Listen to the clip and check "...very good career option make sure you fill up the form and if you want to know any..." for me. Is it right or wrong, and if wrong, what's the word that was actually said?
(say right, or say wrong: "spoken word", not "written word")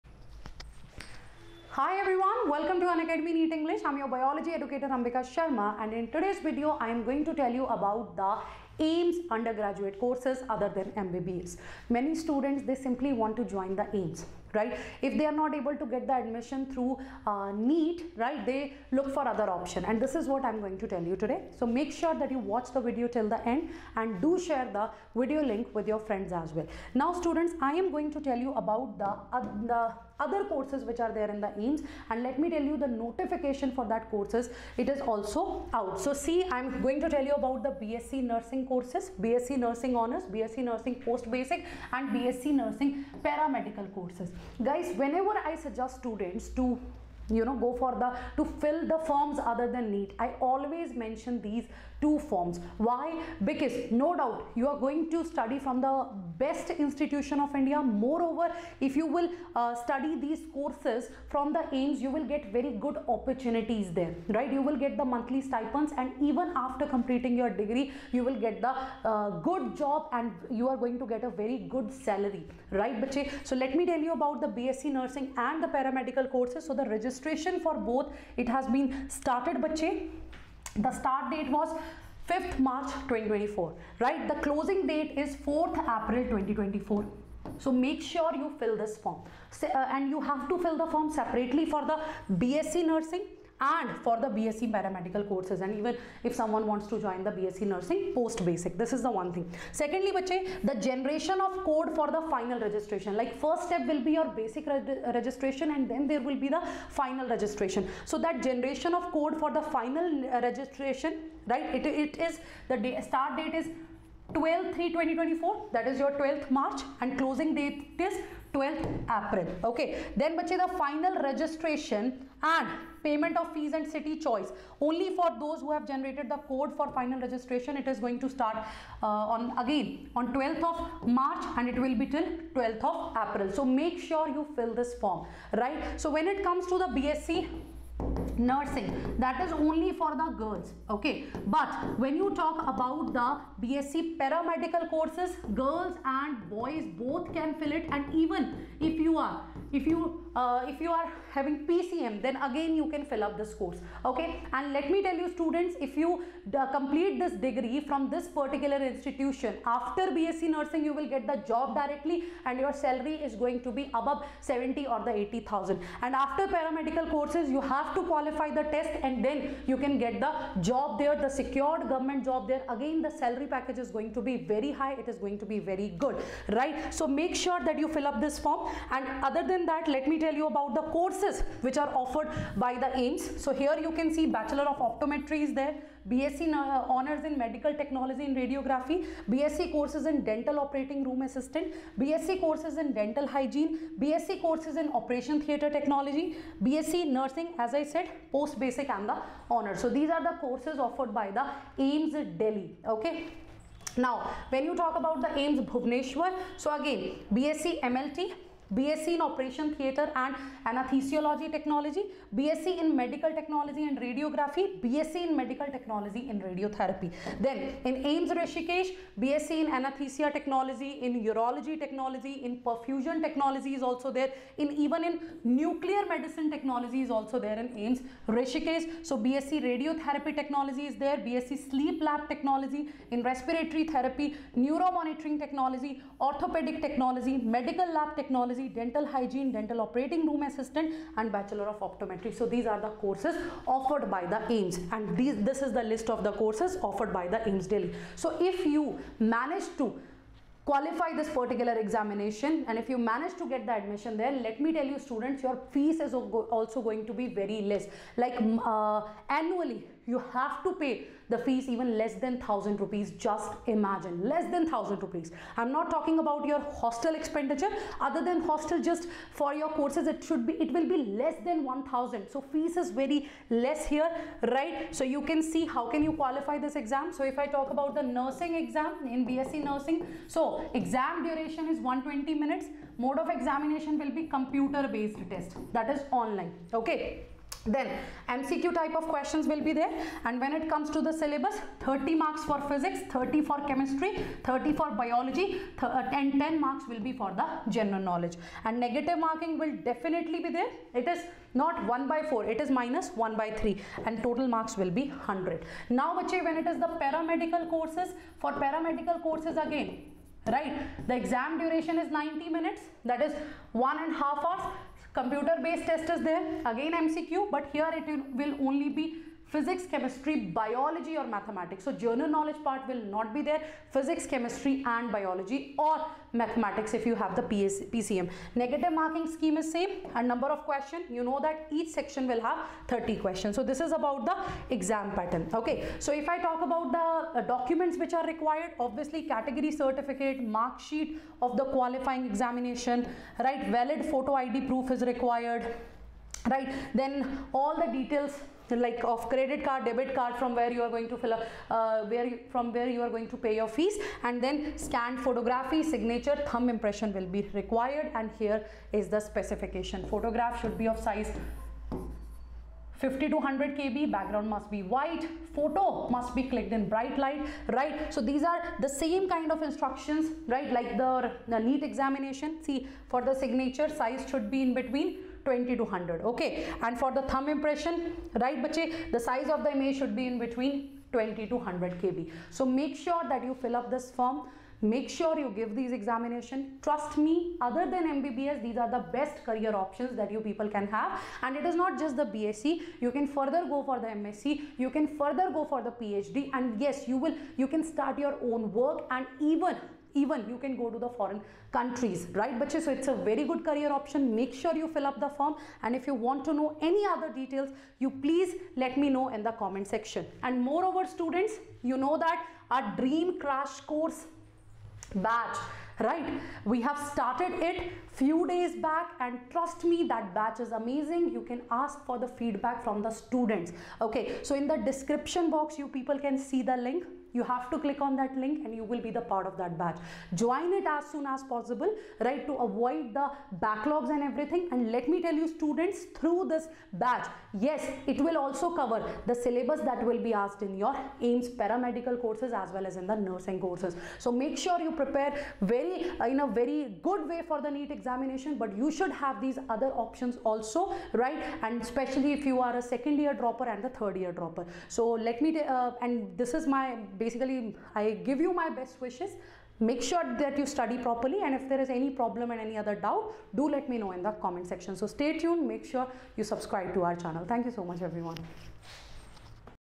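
right.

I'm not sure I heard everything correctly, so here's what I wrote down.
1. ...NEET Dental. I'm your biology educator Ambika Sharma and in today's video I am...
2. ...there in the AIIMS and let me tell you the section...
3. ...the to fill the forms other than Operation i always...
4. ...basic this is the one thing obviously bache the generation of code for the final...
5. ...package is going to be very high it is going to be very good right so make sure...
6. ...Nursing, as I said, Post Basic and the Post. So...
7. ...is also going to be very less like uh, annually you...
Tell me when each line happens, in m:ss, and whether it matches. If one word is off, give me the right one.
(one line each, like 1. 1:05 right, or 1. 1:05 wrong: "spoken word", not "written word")
1. 0:03 wrong: "English", not "Dental"
2. 0:31 wrong: "notification", not "section"
3. 0:48 wrong: "NEET", not "Operation"
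4. 1:38 wrong: "secondly", not "obviously"
5. 2:53 right
6. 3:17 wrong: "Honors", not "Post"
7. 4:15 right.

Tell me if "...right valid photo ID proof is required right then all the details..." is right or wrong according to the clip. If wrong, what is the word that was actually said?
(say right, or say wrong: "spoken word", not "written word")
right.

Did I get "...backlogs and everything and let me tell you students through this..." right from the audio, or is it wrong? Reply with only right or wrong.
right.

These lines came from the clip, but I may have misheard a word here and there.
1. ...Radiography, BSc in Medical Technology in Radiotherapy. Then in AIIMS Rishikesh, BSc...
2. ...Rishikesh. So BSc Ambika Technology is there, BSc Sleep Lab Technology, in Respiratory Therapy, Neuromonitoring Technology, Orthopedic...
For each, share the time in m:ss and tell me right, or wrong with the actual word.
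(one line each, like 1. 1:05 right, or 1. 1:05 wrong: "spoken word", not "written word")
1. 3:33 right
2. 3:48 wrong: "Radiotherapy", not "Ambika".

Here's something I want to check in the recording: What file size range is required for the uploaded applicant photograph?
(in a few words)
50 to 100 kb.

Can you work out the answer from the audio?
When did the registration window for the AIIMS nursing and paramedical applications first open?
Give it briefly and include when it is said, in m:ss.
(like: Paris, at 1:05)
5th March 2024, at 1:22.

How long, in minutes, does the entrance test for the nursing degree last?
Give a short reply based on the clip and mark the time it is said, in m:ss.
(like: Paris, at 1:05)
120 minutes, at 4:41.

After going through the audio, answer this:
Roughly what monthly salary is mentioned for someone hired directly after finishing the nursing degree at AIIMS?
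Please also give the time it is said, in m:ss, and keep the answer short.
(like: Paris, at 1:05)
70 or 80,000, at 2:44.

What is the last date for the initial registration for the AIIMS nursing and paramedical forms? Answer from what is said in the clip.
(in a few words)
4th April 2024.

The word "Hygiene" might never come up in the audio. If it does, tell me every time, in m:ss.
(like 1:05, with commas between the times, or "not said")
3:13, 3:59.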